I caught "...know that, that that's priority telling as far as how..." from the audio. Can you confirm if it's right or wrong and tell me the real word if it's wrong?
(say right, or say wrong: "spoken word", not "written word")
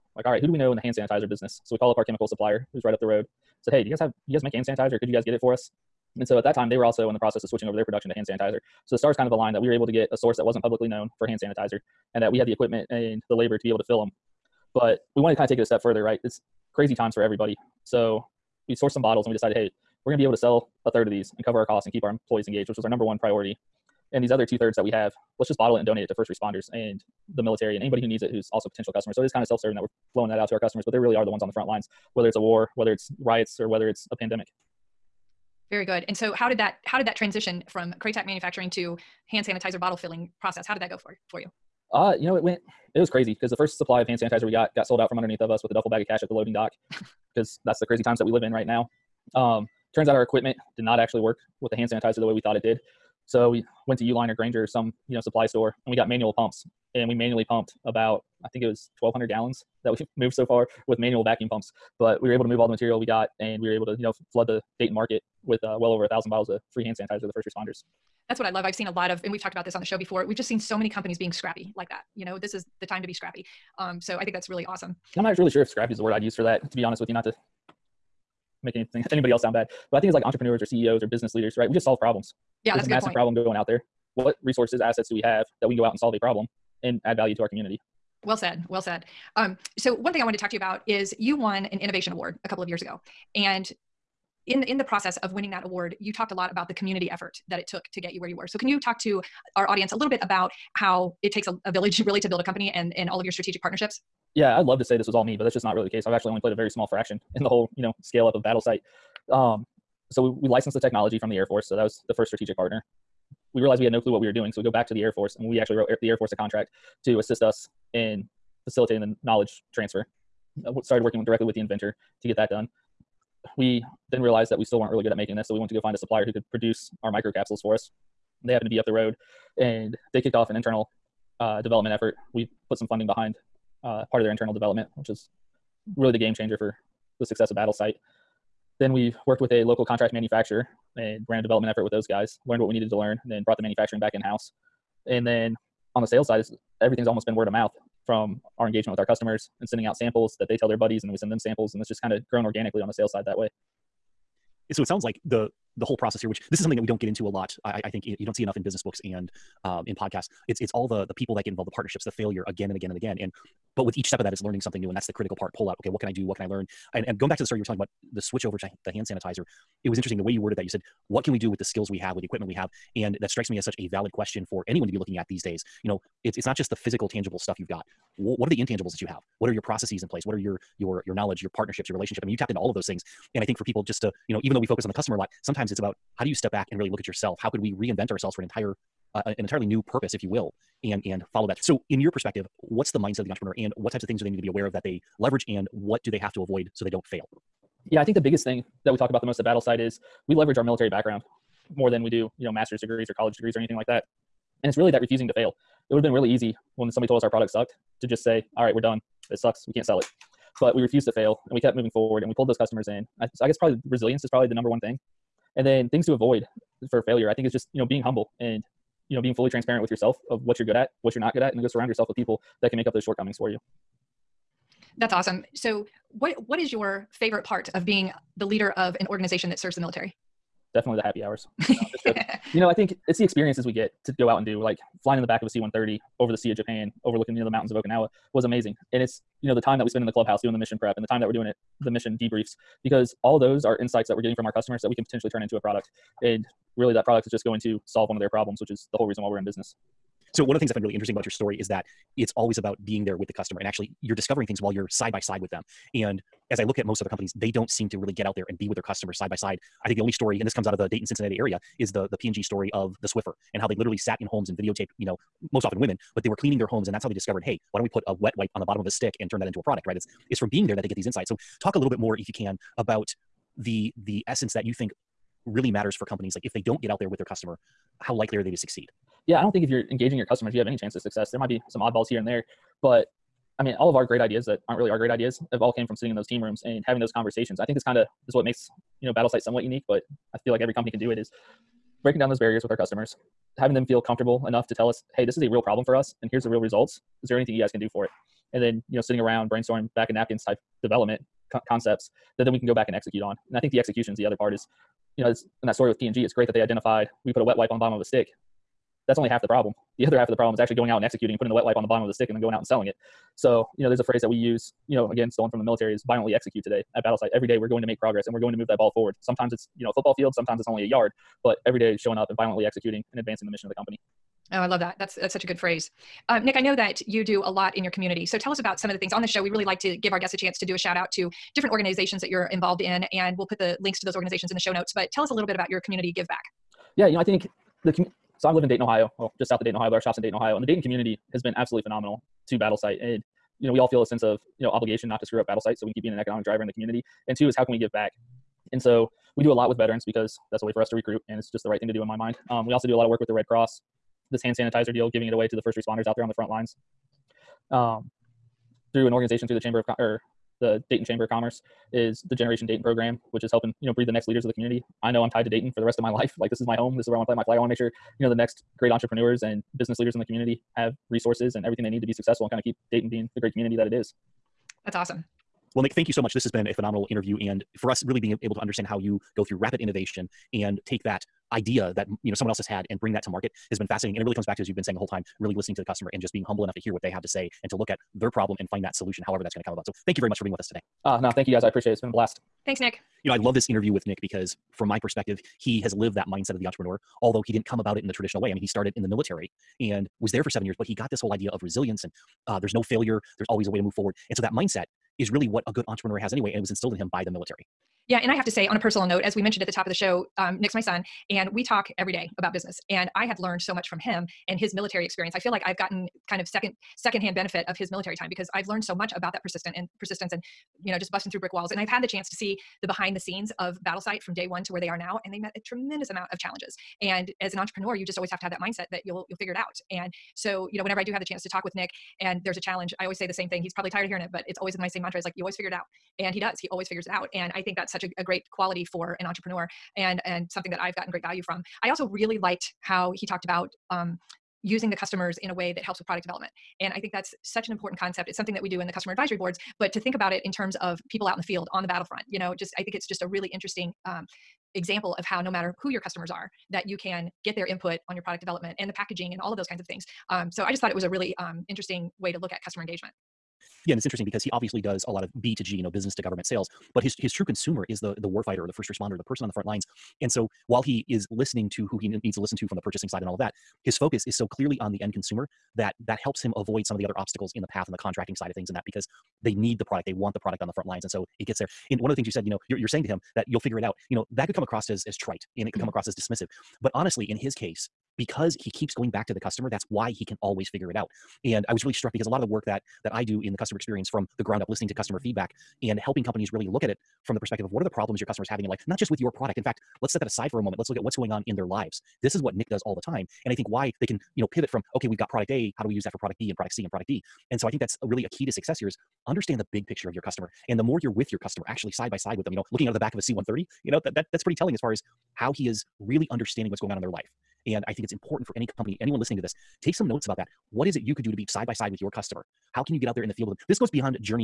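wrong: "pretty", not "priority".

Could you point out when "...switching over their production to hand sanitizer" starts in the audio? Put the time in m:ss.
0:07.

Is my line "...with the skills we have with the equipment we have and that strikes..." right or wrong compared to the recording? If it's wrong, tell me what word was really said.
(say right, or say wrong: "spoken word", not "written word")
right.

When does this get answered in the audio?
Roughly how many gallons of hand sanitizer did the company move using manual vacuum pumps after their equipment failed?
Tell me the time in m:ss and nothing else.
0:59.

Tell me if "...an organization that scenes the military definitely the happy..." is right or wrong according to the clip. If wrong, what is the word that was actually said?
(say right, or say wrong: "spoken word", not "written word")
wrong: "serves", not "scenes".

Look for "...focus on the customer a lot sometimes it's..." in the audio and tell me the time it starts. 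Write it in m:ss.
3:04.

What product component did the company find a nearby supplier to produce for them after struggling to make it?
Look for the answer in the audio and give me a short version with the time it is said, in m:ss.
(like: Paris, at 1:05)
Microcapsules, at 2:07.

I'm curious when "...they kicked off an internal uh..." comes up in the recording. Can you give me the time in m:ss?
2:10.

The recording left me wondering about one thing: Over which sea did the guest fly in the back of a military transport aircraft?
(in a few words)
Sea of Japan.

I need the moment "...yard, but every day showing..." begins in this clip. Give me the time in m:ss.
5:20.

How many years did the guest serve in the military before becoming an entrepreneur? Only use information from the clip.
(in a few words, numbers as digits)
7.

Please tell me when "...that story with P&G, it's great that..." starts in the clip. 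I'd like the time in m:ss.
5:05.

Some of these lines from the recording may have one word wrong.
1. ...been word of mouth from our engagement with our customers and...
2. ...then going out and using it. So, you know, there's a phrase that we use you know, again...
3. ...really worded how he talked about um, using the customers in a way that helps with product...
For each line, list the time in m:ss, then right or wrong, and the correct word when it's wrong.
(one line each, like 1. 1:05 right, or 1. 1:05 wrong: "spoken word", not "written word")
1. 2:27 right
2. 5:12 wrong: "selling", not "using"
3. 7:22 wrong: "liked", not "worded".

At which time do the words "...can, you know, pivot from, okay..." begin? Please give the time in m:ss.
8:24.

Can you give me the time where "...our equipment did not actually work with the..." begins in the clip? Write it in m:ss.
0:50.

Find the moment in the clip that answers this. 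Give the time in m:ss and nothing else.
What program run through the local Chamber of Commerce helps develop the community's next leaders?
6:02.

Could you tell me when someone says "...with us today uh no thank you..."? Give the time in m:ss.
6:30.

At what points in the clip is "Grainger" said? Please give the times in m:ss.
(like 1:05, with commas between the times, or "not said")
0:54.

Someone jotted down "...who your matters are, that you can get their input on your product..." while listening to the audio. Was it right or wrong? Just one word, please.
wrong.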